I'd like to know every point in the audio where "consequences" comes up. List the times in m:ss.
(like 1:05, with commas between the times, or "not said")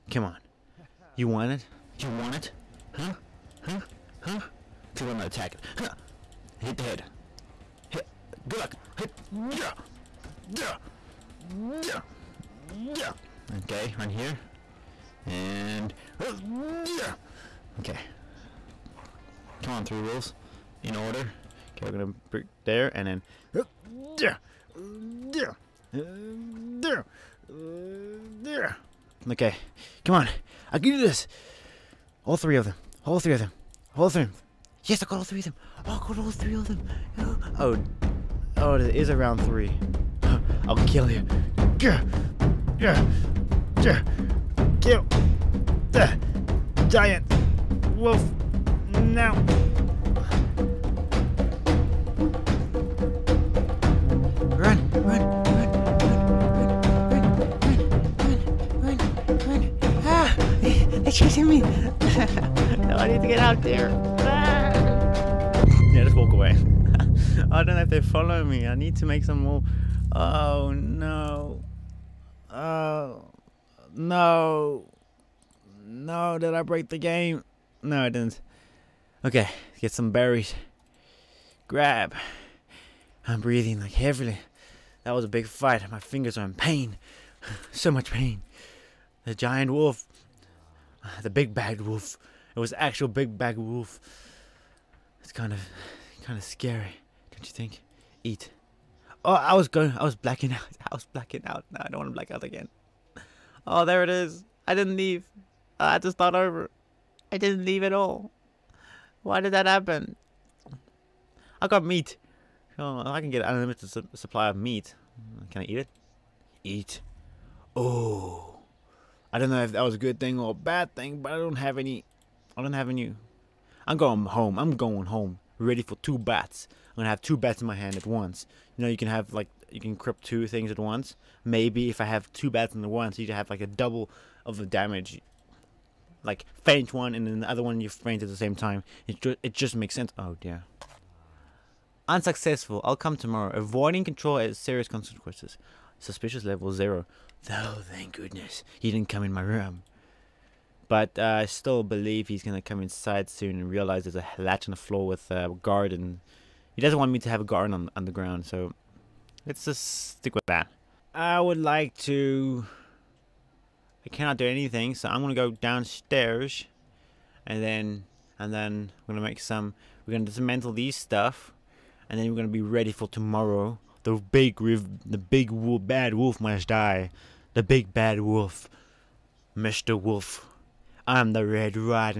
2:24.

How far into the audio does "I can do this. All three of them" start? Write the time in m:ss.
0:30.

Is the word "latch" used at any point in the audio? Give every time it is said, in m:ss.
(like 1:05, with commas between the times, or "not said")
2:34.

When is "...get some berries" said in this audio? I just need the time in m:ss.
1:19.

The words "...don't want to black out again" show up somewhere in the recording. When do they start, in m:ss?
1:41.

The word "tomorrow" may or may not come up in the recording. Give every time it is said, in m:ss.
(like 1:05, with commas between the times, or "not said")
2:23, 2:53.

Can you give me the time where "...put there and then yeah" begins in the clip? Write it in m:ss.
0:22.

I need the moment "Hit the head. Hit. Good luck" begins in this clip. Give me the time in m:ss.
0:06.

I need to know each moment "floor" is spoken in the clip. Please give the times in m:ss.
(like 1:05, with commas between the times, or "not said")
2:34.